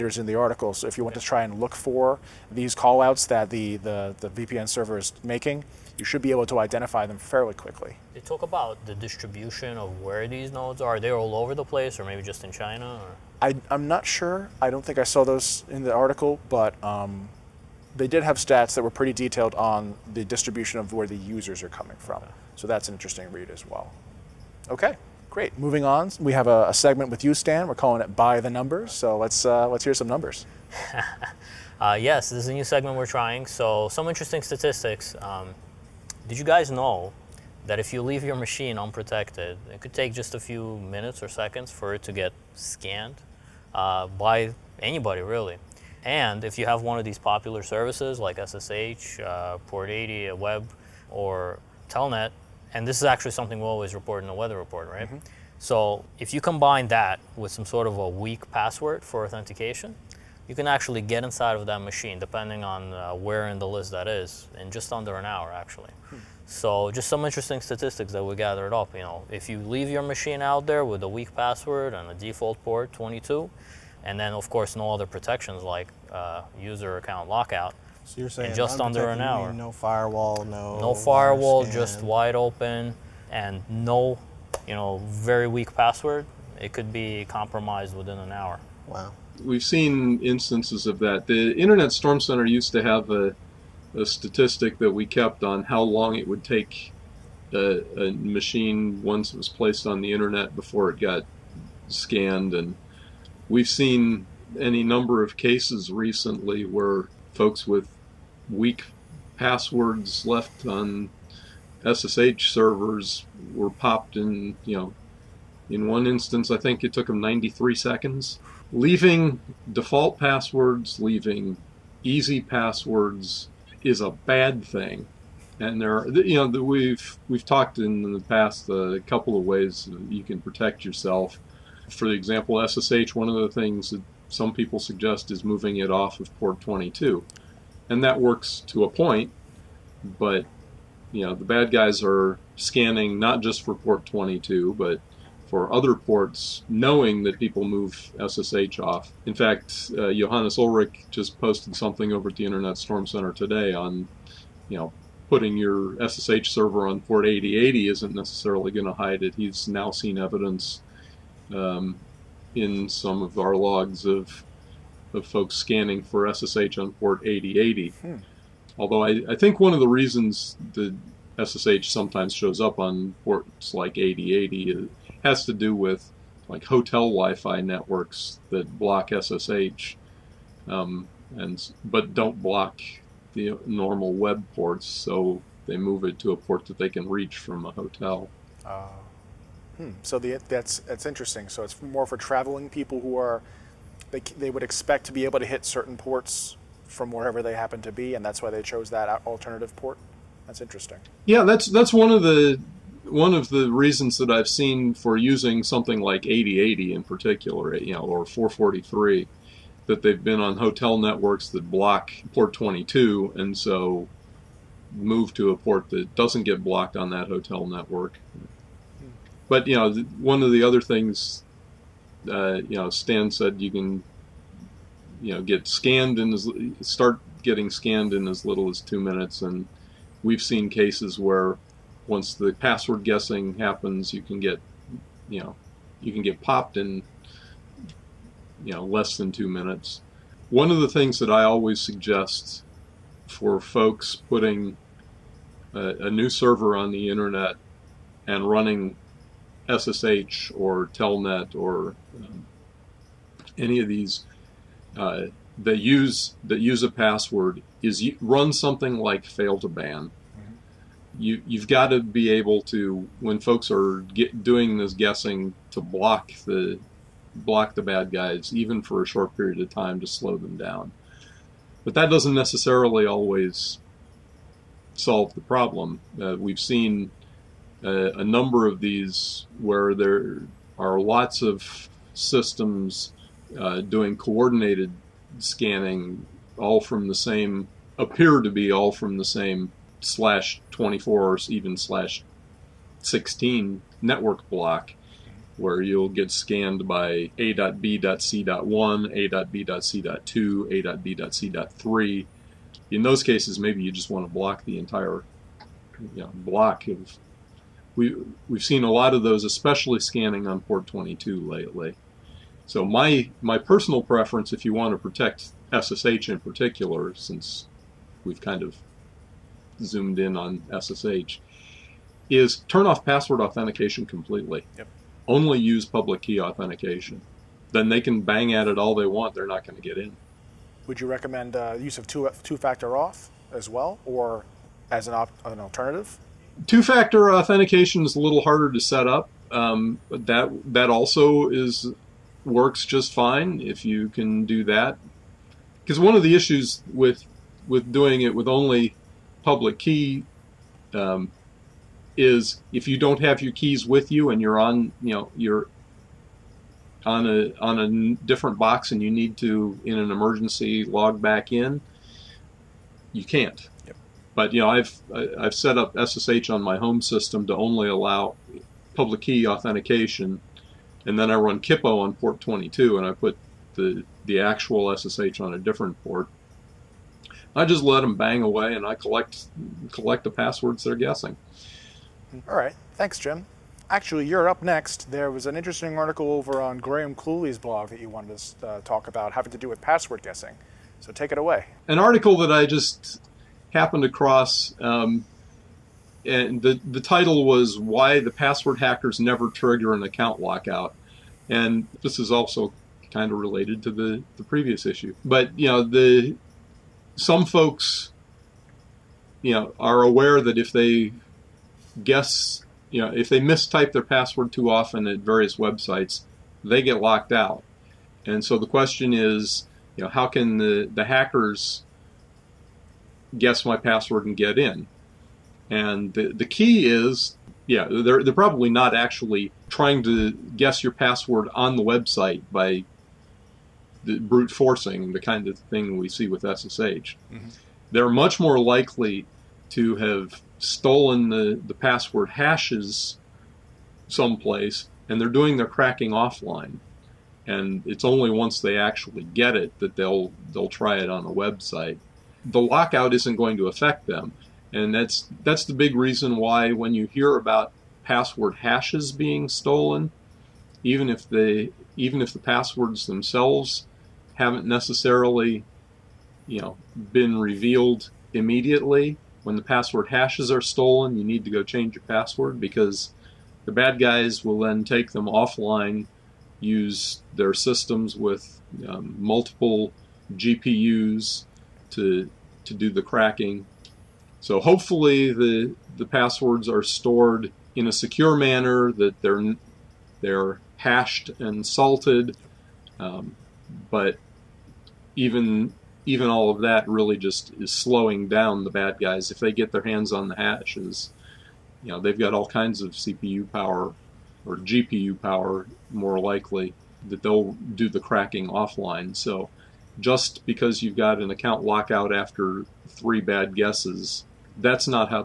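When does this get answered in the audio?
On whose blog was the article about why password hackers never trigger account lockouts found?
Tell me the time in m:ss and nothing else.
6:26.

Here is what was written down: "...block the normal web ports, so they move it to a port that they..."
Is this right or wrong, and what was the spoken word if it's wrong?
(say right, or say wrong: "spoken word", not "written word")
right.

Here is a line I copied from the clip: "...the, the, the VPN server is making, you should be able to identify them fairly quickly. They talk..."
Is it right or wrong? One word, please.
right.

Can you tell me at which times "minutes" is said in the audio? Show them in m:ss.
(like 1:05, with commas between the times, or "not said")
0:40, 3:48, 3:59.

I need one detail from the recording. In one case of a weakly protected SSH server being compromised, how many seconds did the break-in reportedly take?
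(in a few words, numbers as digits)
93.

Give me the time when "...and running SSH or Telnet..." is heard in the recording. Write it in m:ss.
4:08.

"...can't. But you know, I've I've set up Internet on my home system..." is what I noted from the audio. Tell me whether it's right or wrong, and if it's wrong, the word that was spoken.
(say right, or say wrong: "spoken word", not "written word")
wrong: "SSH", not "Internet".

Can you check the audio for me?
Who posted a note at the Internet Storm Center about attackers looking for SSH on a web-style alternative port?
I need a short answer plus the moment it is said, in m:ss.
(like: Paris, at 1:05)
Johannes Ulrich, at 2:30.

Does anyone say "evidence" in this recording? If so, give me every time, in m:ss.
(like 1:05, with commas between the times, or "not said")
2:40.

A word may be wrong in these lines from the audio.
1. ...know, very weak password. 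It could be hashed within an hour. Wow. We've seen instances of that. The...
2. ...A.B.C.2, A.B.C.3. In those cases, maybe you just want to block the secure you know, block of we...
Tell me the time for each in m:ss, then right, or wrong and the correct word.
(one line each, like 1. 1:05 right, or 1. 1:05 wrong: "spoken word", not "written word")
1. 1:24 wrong: "compromised", not "hashed"
2. 4:59 wrong: "entire", not "secure".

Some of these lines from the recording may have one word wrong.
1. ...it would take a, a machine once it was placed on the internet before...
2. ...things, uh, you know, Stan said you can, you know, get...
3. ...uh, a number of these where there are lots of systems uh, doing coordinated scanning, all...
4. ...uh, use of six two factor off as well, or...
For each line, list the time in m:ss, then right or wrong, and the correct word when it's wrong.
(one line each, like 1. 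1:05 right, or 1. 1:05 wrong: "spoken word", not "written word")
1. 1:36 right
2. 3:40 right
3. 4:37 right
4. 5:31 wrong: "two", not "six".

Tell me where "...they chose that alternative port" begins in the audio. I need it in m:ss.
3:18.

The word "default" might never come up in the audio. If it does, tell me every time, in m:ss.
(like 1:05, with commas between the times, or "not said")
1:12, 1:59.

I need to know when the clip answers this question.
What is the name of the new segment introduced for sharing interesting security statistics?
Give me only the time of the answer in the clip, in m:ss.
0:28.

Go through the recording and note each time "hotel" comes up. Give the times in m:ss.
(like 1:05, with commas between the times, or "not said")
2:56, 3:07, 3:30, 3:37.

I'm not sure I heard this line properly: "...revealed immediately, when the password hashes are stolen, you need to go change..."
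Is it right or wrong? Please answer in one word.
right.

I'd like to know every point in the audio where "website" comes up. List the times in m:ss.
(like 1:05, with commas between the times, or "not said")
6:55, 7:11, 7:31.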